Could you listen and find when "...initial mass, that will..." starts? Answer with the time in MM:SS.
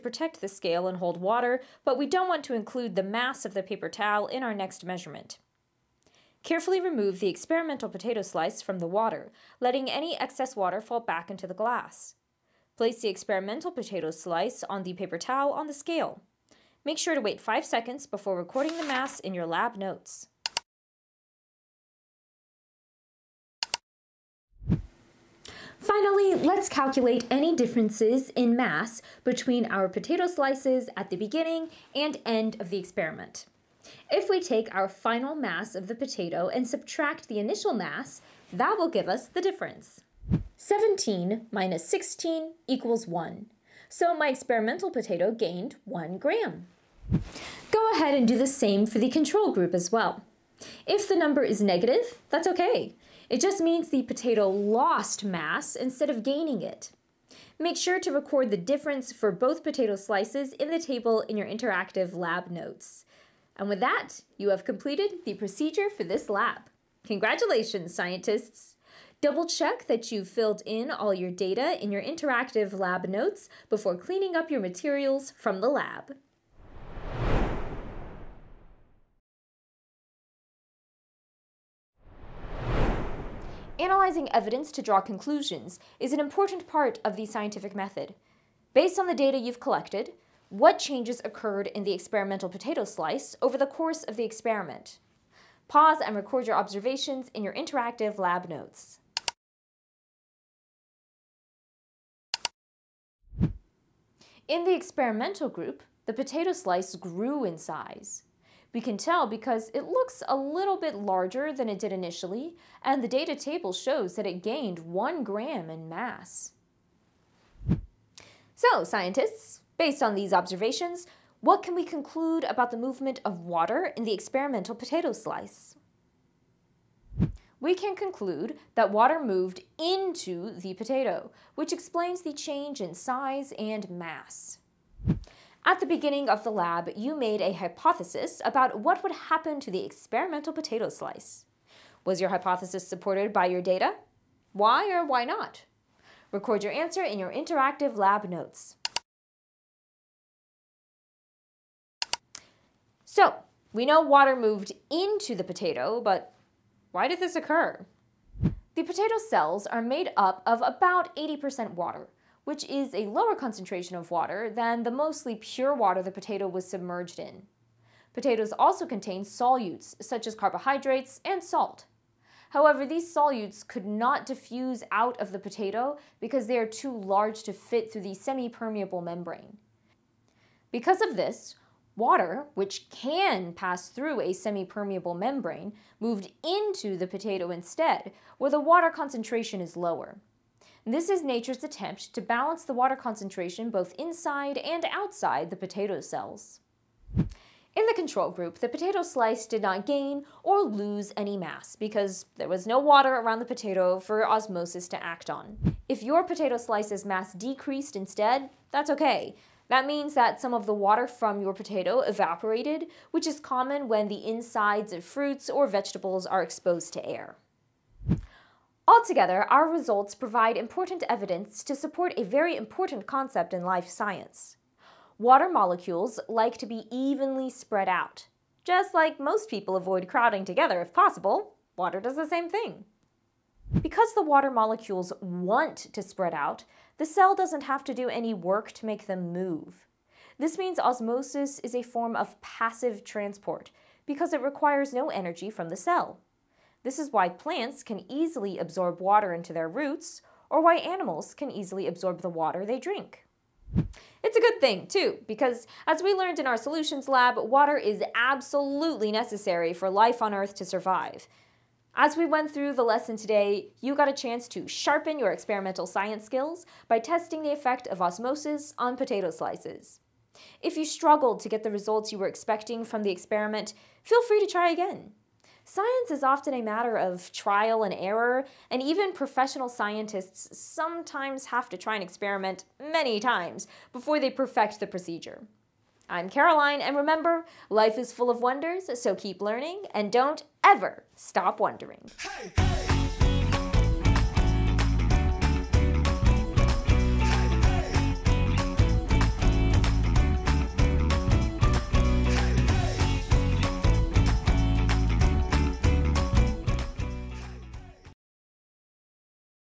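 00:37.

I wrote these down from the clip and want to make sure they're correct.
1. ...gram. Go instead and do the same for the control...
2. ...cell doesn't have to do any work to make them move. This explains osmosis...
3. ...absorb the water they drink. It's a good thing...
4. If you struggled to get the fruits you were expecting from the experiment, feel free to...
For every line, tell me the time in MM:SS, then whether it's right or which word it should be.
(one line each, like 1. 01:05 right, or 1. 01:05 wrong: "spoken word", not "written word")
1. 00:46 wrong: "ahead", not "instead"
2. 03:57 wrong: "means", not "explains"
3. 04:11 right
4. 04:30 wrong: "results", not "fruits".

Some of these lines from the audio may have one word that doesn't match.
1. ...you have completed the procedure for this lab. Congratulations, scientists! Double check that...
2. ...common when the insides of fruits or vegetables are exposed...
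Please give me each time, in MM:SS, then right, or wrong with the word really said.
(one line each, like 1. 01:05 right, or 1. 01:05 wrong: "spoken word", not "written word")
1. 01:04 right
2. 03:33 right.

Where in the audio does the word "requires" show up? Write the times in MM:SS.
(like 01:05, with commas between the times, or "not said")
04:04.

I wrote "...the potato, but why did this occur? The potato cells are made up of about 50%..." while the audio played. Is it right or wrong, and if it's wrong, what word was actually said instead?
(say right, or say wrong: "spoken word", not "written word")
wrong: "80", not "50".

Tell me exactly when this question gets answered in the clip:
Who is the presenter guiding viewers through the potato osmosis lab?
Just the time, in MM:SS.
04:46.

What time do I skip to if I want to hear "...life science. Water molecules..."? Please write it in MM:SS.
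03:43.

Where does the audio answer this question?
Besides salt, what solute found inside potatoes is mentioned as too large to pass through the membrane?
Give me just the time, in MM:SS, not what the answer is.
02:50.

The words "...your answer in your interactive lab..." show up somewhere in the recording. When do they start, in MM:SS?
02:26.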